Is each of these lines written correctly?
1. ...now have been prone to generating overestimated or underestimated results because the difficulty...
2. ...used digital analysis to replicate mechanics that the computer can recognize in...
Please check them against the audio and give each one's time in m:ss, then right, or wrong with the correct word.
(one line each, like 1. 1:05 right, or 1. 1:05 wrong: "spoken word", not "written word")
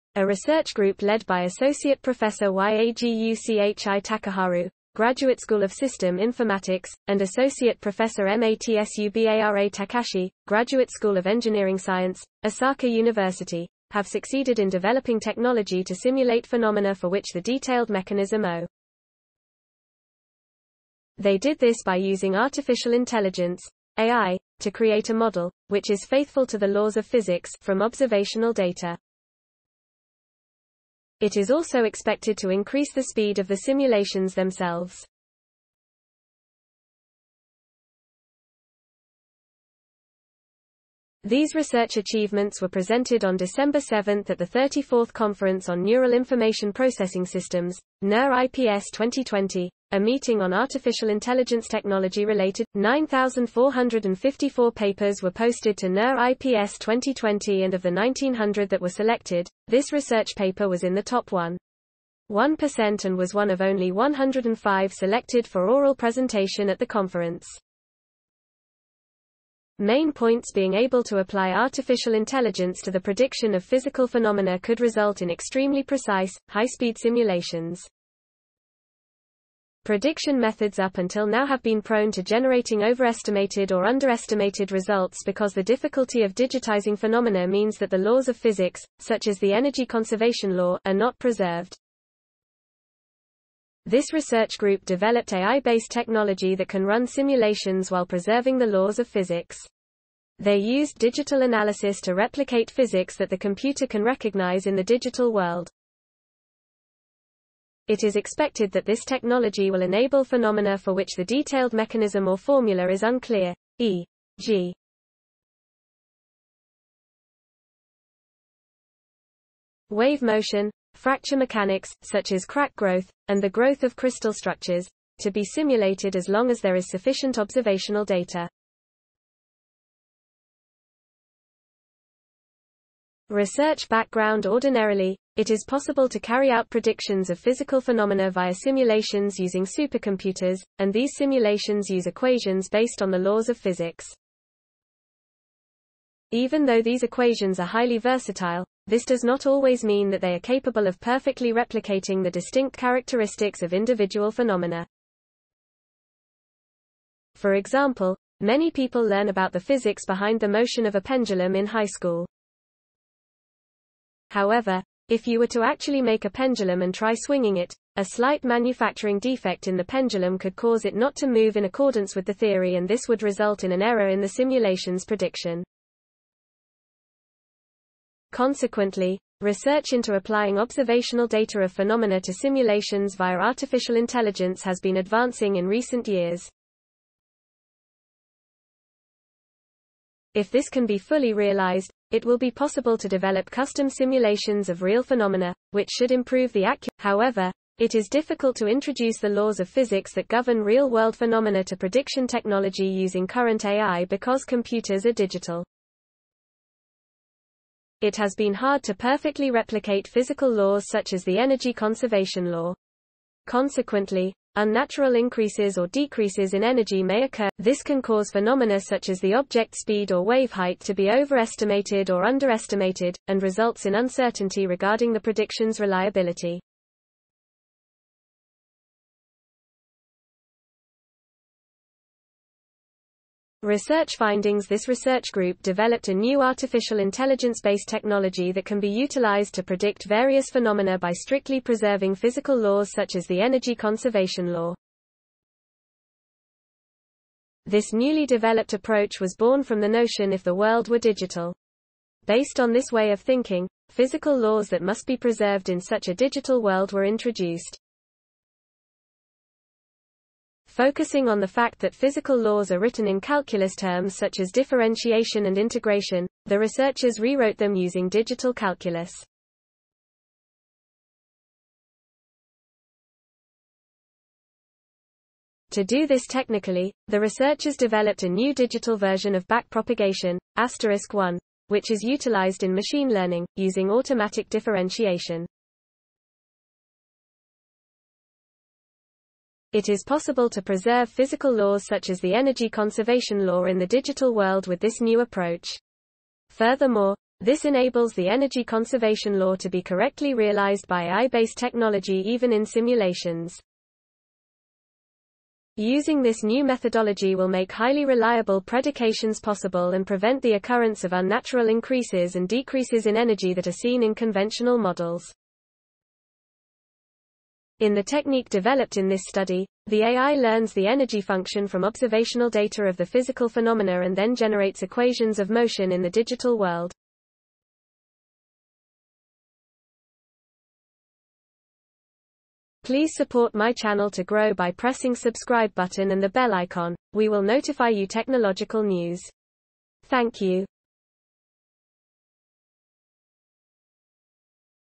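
1. 1:21 right
2. 1:40 wrong: "physics", not "mechanics".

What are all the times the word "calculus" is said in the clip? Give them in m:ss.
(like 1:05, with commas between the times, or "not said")
4:23, 4:28.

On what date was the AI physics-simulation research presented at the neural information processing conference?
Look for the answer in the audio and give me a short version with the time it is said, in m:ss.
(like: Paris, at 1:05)
December 7, at 0:43.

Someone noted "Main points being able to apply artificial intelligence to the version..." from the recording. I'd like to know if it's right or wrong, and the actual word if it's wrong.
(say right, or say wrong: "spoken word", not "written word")
wrong: "prediction", not "version".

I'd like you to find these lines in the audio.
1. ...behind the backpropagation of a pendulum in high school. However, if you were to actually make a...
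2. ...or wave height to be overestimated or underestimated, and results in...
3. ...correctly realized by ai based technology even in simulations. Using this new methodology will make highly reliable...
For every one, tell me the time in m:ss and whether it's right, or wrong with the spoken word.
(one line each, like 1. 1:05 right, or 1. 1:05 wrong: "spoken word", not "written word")
1. 2:40 wrong: "motion", not "backpropagation"
2. 3:40 right
3. 4:59 right.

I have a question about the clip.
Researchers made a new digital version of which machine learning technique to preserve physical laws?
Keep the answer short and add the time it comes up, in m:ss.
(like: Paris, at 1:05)
backpropagation, at 4:39.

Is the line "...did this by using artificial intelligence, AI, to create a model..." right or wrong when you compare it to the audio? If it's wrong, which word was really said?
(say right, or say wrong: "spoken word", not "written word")
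right.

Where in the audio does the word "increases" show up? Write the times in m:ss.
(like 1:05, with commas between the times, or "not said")
0:32, 3:35, 5:11.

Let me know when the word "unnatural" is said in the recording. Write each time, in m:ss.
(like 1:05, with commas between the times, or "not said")
3:34, 5:11.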